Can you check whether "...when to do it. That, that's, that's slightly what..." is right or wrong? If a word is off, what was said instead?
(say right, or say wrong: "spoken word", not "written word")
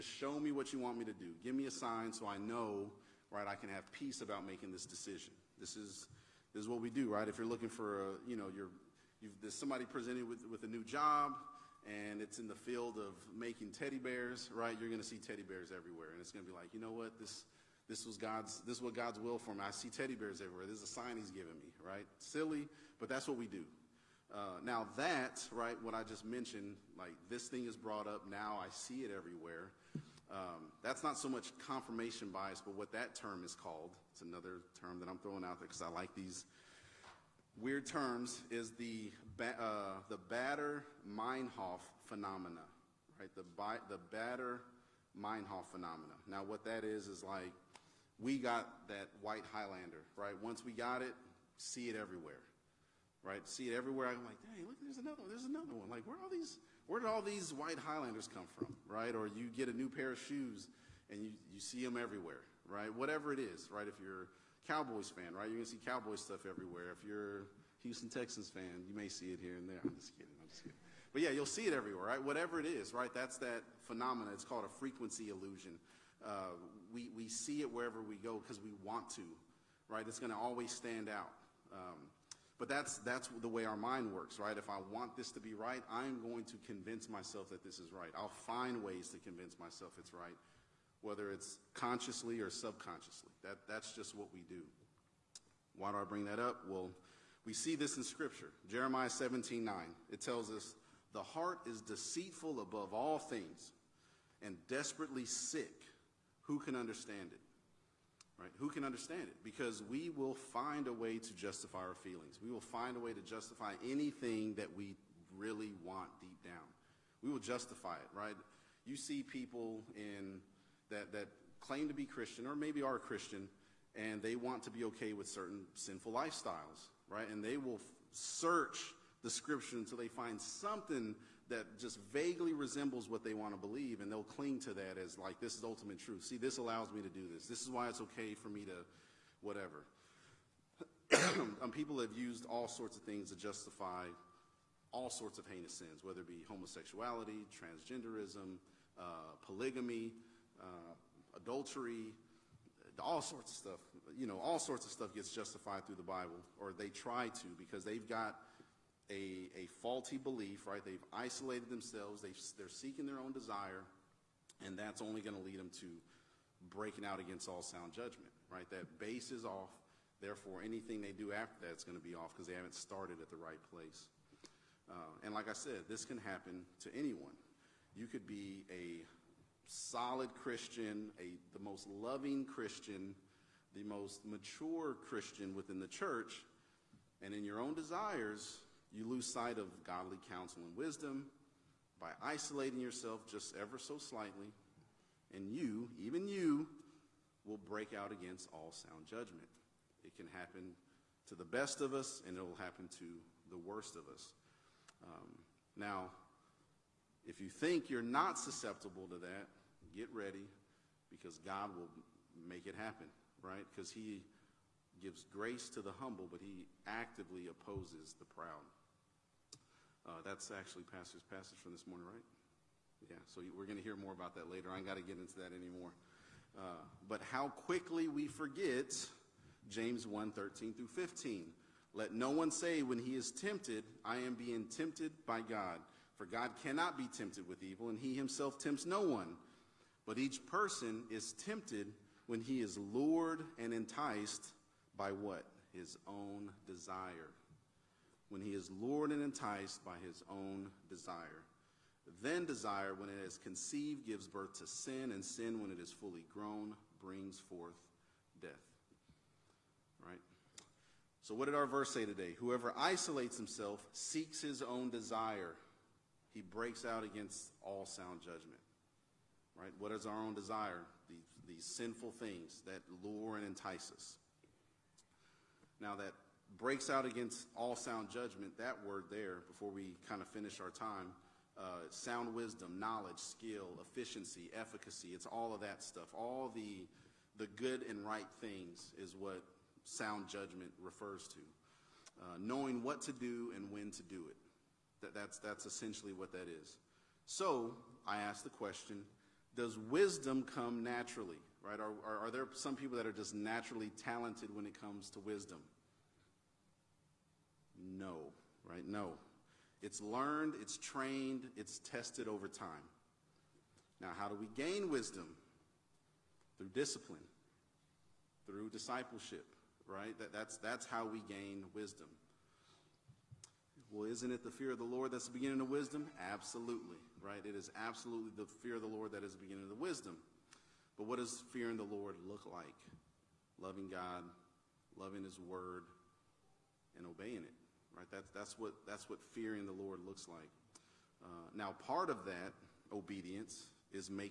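wrong: "essentially", not "slightly".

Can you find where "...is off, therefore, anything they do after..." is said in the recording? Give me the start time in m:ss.
2:49.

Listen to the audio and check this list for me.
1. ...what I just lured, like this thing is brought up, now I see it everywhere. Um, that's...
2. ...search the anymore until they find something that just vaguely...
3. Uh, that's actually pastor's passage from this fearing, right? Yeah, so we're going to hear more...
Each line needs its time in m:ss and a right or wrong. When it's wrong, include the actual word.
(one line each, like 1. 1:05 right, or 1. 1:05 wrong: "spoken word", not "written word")
1. 0:25 wrong: "mentioned", not "lured"
2. 2:08 wrong: "scripture", not "anymore"
3. 3:40 wrong: "morning", not "fearing".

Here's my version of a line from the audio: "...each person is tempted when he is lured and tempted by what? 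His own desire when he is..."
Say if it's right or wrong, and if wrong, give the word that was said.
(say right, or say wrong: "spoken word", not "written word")
wrong: "enticed", not "tempted".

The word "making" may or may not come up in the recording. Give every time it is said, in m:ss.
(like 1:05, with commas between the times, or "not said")
0:04, 0:13.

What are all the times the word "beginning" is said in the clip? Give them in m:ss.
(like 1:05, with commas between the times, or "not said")
5:25, 5:29.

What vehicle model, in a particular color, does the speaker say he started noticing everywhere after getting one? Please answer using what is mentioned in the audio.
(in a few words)
white Highlander.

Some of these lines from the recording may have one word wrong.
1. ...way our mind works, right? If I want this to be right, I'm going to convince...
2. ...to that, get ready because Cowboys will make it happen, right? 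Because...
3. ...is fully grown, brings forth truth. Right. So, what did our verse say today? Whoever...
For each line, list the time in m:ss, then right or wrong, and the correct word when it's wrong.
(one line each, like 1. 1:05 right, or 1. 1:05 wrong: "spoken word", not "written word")
1. 1:23 right
2. 3:29 wrong: "God", not "Cowboys"
3. 4:15 wrong: "death", not "truth".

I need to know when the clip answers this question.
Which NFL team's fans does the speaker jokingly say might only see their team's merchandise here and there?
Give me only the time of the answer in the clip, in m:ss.
1:07.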